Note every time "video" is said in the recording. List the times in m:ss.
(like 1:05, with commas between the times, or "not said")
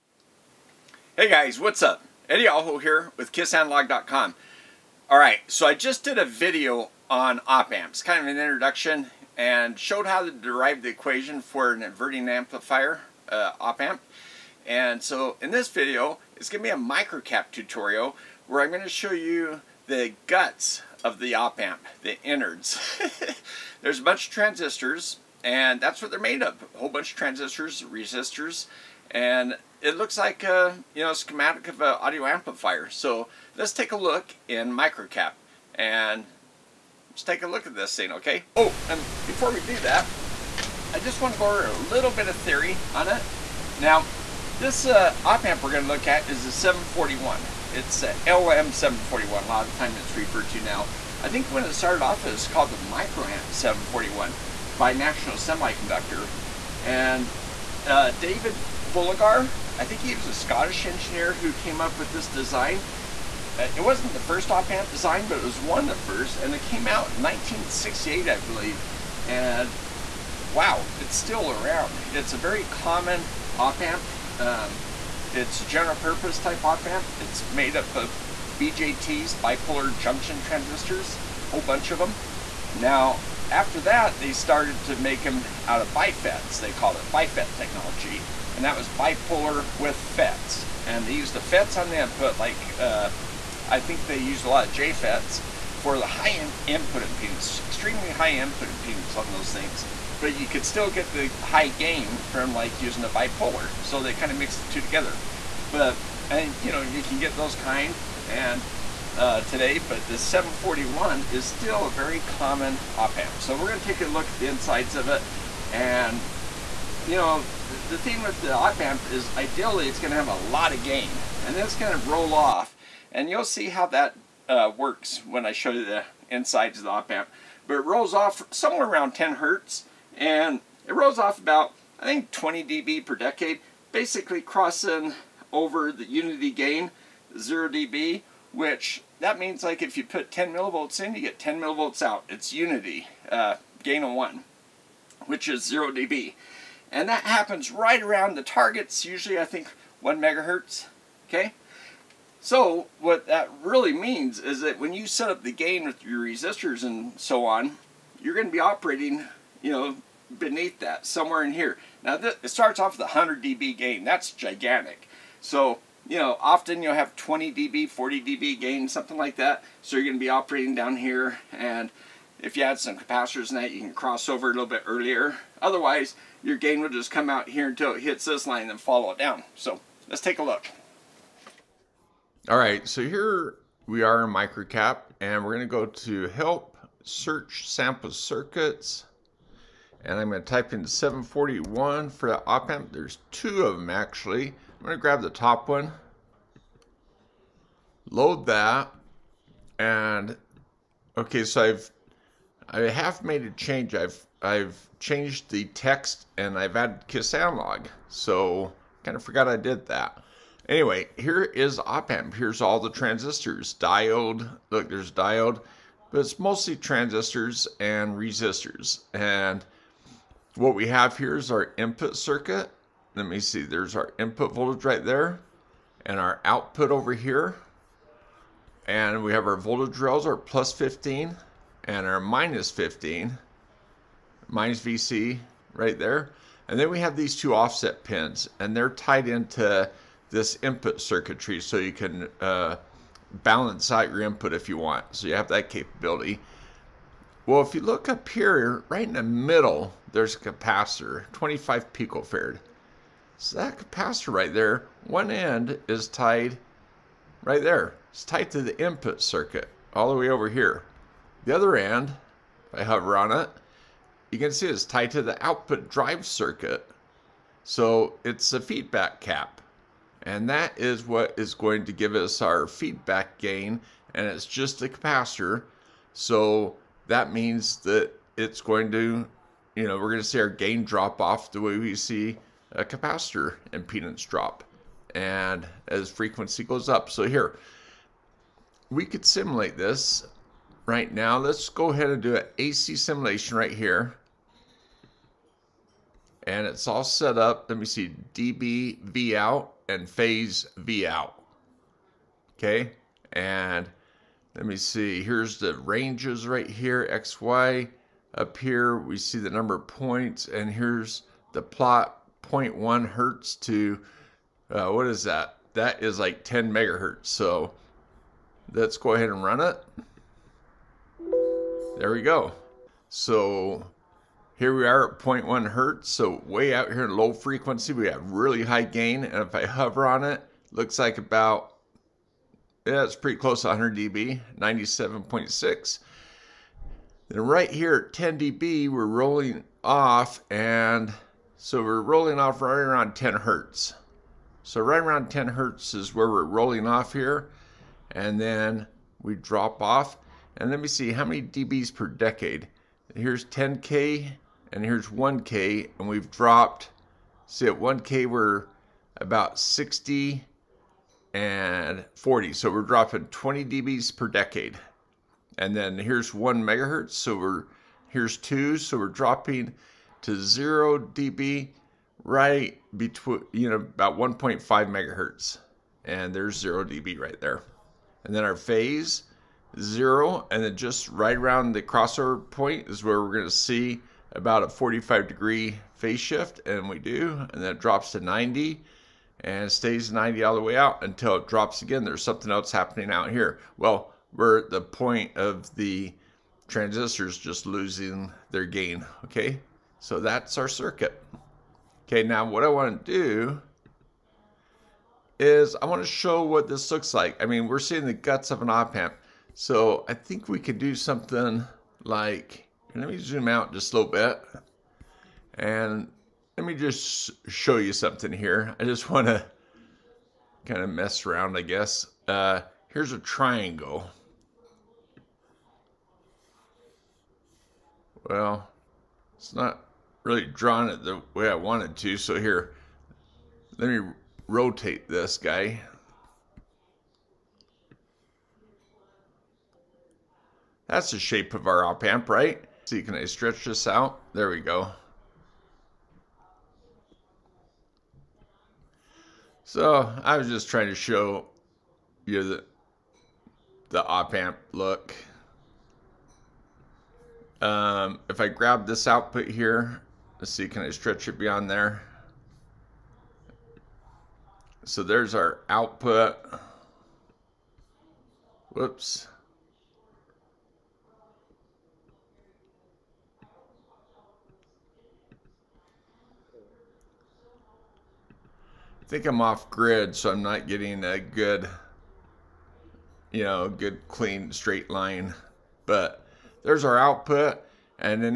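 0:06, 0:15.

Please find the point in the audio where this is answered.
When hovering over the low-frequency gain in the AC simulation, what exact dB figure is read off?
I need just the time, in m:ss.
5:34.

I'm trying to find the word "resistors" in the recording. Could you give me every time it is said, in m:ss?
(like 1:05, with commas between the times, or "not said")
0:27, 2:36, 3:38.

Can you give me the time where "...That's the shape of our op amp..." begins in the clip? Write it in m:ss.
7:20.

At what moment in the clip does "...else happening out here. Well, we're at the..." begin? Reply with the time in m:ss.
6:32.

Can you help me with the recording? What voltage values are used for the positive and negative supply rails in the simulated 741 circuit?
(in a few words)
plus and minus 15.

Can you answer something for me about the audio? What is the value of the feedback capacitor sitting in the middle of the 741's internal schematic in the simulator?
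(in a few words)
25 picofarad.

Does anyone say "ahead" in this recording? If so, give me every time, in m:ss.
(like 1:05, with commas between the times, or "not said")
4:51, 5:19.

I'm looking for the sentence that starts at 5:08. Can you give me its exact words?
Up here, we see the number of points, and here's the plot 0.1 hertz to, uh, what is that?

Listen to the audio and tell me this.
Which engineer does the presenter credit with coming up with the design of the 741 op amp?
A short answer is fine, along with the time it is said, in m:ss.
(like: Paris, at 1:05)
David Fullagar, at 0:58.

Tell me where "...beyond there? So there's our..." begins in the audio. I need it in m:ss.
7:41.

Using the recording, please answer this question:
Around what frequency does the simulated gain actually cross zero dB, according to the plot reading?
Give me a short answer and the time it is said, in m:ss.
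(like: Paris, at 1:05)
1.5 megahertz, at 6:14.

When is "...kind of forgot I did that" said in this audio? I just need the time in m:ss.
3:29.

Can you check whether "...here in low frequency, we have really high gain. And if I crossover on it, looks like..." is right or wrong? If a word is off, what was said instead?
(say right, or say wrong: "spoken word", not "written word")
wrong: "hover", not "crossover".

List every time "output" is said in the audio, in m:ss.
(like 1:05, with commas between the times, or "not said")
3:46, 4:25, 7:39, 7:45, 8:06.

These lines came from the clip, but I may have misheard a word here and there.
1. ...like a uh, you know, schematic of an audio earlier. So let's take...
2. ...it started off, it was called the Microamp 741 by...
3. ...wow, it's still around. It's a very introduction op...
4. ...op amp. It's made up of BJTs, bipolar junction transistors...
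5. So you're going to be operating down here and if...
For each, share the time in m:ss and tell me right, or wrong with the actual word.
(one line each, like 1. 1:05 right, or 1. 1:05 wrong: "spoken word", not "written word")
1. 0:30 wrong: "amplifier", not "earlier"
2. 0:51 right
3. 1:10 wrong: "common", not "introduction"
4. 1:16 right
5. 2:49 right.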